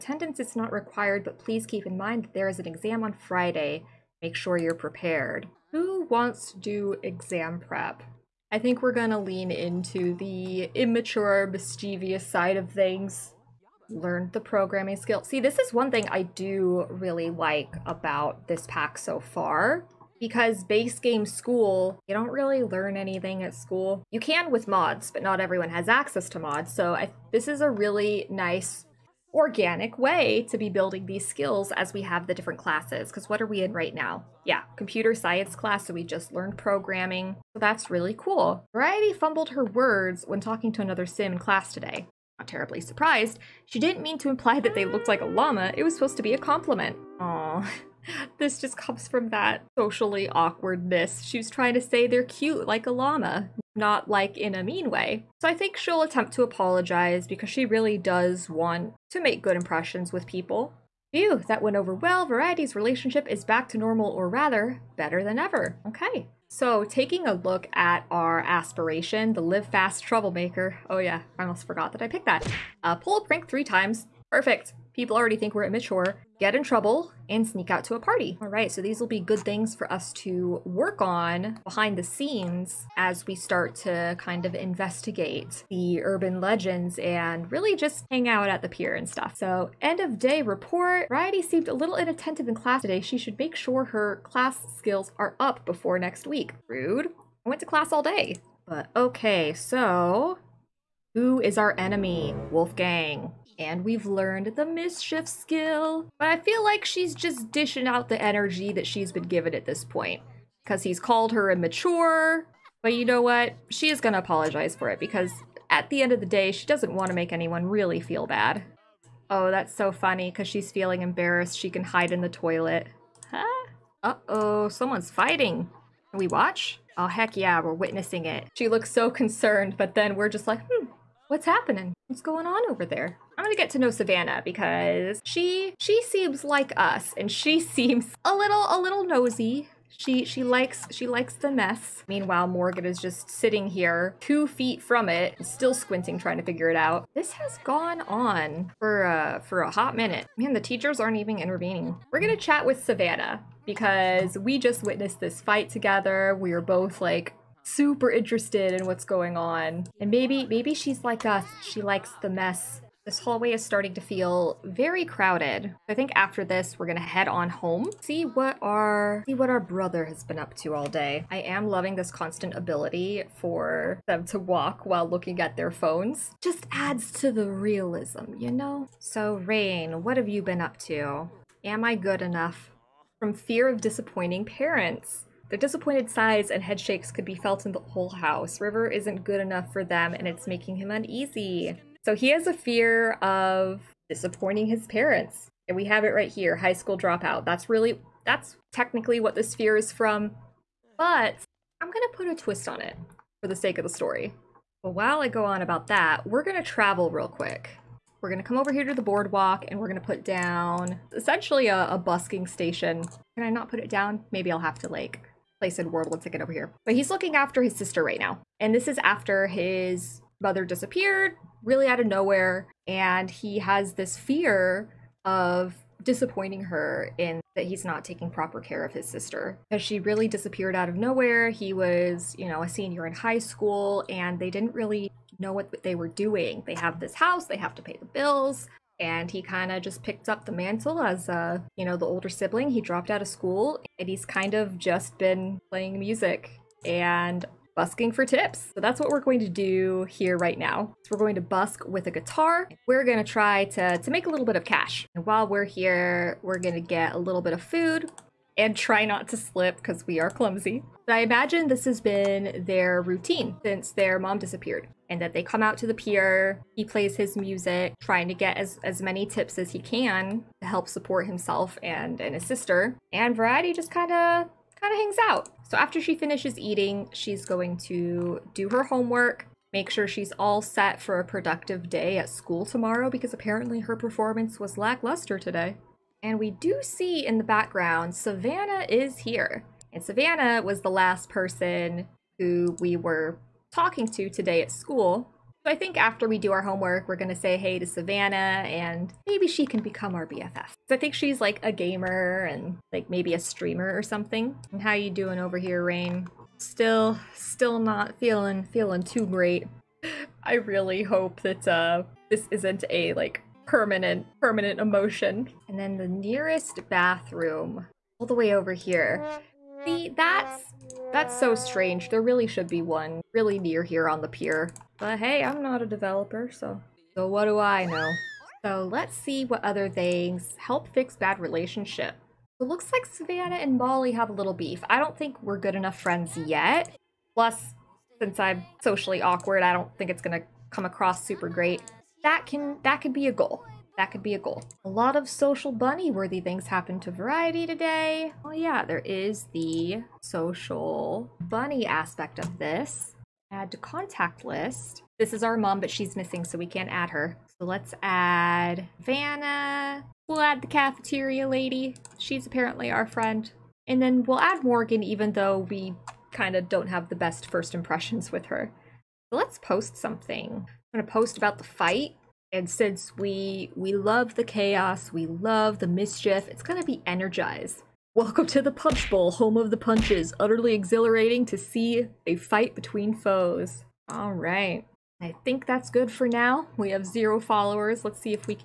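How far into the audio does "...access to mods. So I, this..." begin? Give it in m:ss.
0:25.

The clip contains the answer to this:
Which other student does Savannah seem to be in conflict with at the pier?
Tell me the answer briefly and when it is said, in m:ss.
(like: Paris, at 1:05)
Molly, at 5:33.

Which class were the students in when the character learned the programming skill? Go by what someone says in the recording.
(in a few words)
Computer science.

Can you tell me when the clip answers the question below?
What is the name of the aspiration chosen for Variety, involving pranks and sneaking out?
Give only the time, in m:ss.
1:09.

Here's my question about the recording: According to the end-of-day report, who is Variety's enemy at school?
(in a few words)
Wolfgang.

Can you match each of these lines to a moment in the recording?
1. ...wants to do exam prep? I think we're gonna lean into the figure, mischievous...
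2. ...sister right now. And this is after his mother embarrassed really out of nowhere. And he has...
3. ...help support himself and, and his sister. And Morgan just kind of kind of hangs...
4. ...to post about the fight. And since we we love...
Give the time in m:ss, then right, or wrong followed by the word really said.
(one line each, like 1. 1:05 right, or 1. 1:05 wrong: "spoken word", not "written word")
1. 0:06 wrong: "immature", not "figure"
2. 3:37 wrong: "disappeared", not "embarrassed"
3. 4:30 wrong: "Variety", not "Morgan"
4. 6:11 right.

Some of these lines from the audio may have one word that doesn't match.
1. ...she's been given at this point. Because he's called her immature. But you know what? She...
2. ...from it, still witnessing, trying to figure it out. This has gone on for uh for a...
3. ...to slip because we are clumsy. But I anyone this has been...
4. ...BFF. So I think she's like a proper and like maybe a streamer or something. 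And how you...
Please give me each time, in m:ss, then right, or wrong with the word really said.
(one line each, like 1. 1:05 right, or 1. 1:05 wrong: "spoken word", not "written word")
1. 1:48 right
2. 2:24 wrong: "squinting", not "witnessing"
3. 4:19 wrong: "imagine", not "anyone"
4. 5:00 wrong: "gamer", not "proper".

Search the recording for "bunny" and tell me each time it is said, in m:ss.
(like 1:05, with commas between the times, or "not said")
5:45, 5:51.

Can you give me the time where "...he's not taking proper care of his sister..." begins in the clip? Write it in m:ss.
3:47.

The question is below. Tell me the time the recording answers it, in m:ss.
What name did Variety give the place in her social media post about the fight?
6:18.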